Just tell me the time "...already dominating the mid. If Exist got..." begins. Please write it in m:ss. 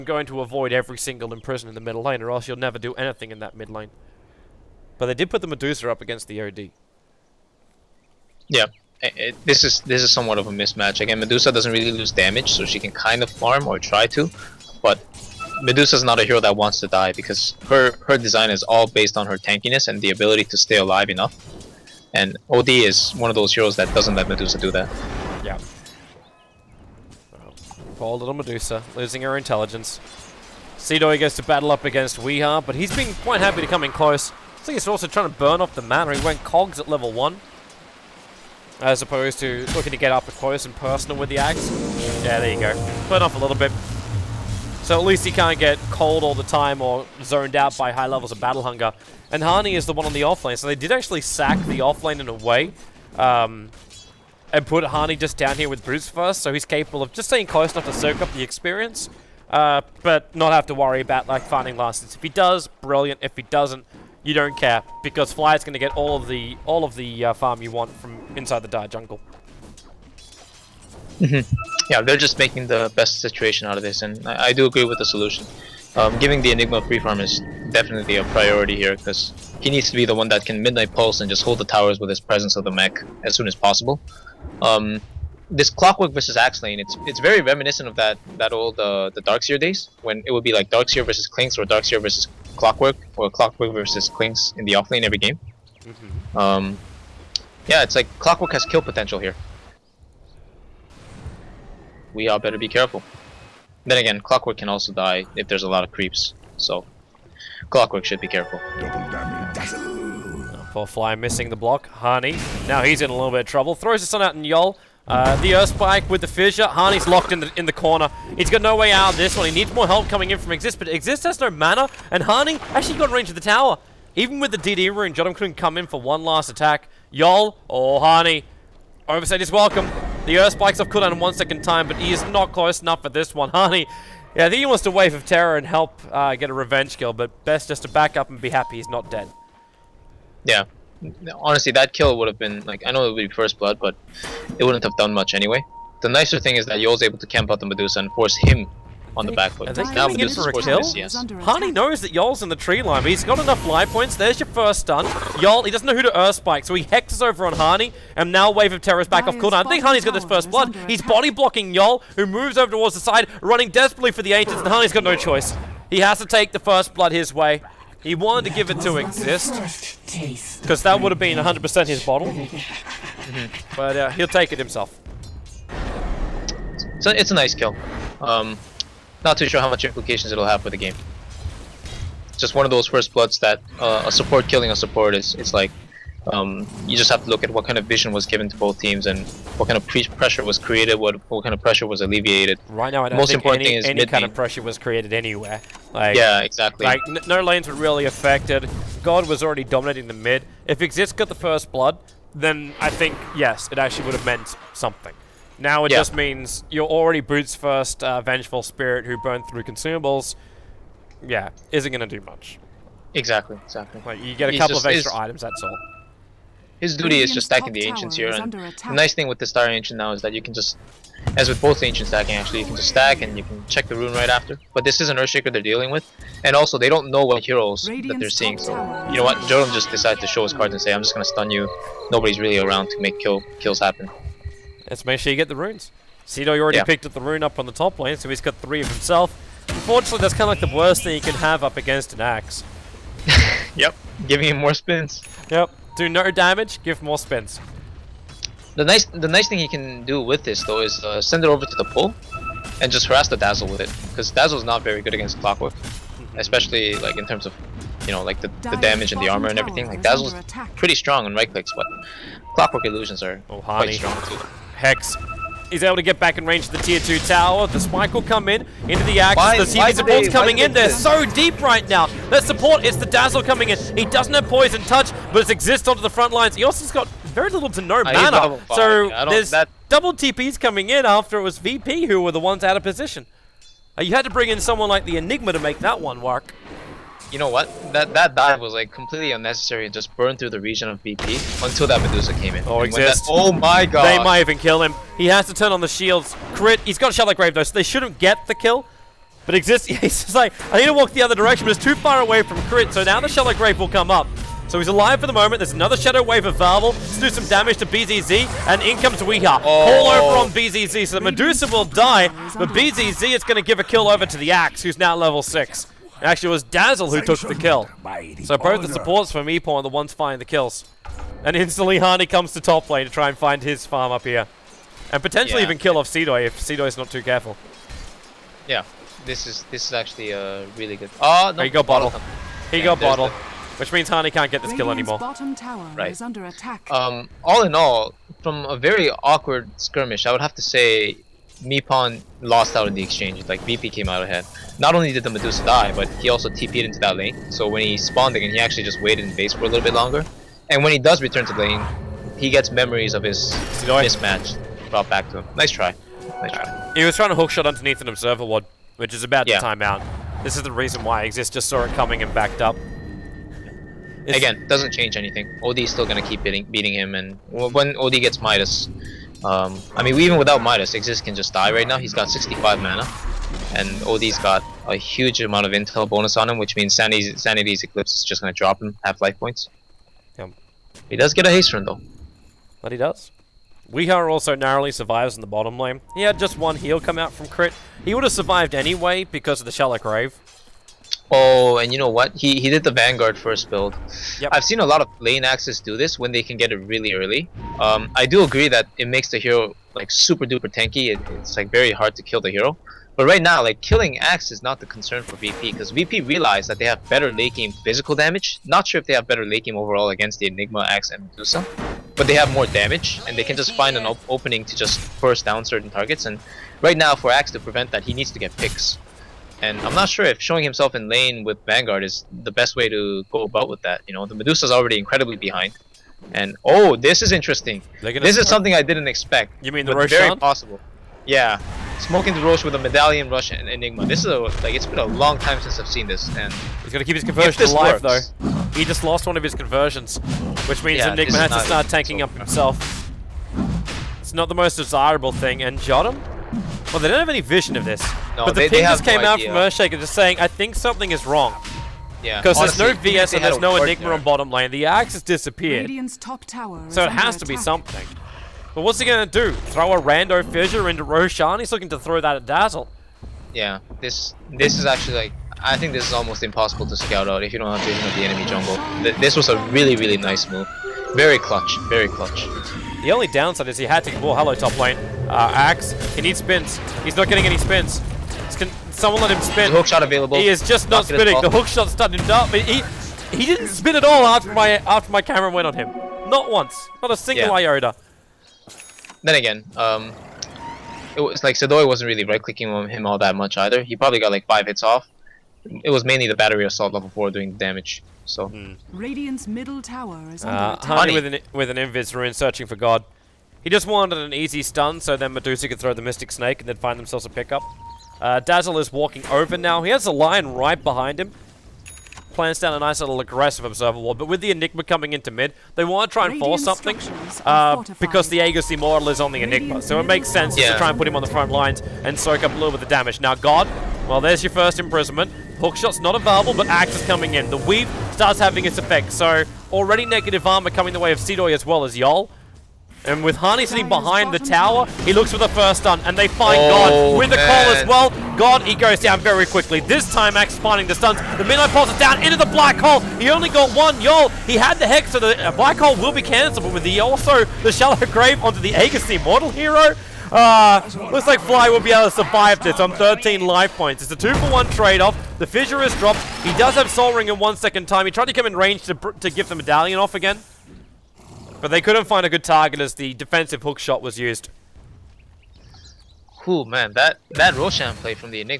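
3:19.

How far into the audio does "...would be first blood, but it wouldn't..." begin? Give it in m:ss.
2:23.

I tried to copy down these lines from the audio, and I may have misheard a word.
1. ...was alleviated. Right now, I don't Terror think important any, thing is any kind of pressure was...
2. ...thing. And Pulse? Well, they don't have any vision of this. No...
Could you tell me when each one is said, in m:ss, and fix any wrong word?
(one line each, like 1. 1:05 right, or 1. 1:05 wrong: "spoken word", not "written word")
1. 3:11 wrong: "Most", not "Terror"
2. 7:25 wrong: "Jotam", not "Pulse".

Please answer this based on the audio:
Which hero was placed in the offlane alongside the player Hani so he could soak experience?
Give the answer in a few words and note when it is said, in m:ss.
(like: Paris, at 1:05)
Bruce, at 0:54.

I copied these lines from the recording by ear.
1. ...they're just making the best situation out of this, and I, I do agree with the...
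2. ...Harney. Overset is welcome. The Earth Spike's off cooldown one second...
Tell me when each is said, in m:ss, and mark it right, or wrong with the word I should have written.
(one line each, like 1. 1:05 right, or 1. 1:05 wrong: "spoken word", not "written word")
1. 1:12 right
2. 2:07 right.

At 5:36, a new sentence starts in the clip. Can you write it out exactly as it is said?
Um, all in all, from a very awkward skirmish, I would have to say Mi lost out in the exchange.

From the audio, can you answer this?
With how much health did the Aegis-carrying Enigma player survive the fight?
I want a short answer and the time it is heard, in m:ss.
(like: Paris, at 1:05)
13, at 9:12.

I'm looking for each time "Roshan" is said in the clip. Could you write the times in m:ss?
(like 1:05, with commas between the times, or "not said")
7:41, 9:27.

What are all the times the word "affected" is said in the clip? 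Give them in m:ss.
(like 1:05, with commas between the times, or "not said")
3:18.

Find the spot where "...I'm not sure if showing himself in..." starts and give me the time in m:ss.
6:59.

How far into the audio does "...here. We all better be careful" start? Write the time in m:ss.
1:39.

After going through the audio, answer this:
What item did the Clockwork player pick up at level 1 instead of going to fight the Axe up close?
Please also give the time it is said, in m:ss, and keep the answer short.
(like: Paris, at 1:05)
Cogs, at 0:36.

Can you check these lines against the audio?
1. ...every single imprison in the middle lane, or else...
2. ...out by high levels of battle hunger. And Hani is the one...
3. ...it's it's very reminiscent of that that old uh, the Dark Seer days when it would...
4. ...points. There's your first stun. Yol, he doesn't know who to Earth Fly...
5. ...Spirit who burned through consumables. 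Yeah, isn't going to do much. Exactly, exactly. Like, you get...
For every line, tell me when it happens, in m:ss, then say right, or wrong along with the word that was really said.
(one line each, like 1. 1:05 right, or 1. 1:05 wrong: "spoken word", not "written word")
1. 0:00 right
2. 0:47 right
3. 1:26 right
4. 2:33 wrong: "Spike", not "Fly"
5. 3:28 right.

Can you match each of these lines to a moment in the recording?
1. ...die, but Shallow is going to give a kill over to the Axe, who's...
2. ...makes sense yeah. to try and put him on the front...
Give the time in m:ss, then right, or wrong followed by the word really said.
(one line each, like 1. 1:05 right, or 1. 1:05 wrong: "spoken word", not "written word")
1. 5:11 wrong: "BZZ", not "Shallow"
2. 8:40 right.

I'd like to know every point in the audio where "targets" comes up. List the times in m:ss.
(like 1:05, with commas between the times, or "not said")
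6:55, 9:22.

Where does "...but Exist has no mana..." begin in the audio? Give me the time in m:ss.
2:00.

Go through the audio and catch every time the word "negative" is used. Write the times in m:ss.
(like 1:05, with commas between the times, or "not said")
8:50.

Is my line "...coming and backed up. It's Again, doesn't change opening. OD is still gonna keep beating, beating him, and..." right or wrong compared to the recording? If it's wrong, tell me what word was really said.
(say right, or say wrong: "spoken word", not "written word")
wrong: "anything", not "opening".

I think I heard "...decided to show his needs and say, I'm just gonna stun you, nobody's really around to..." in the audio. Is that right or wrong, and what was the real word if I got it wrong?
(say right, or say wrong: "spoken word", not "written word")
wrong: "cards", not "needs".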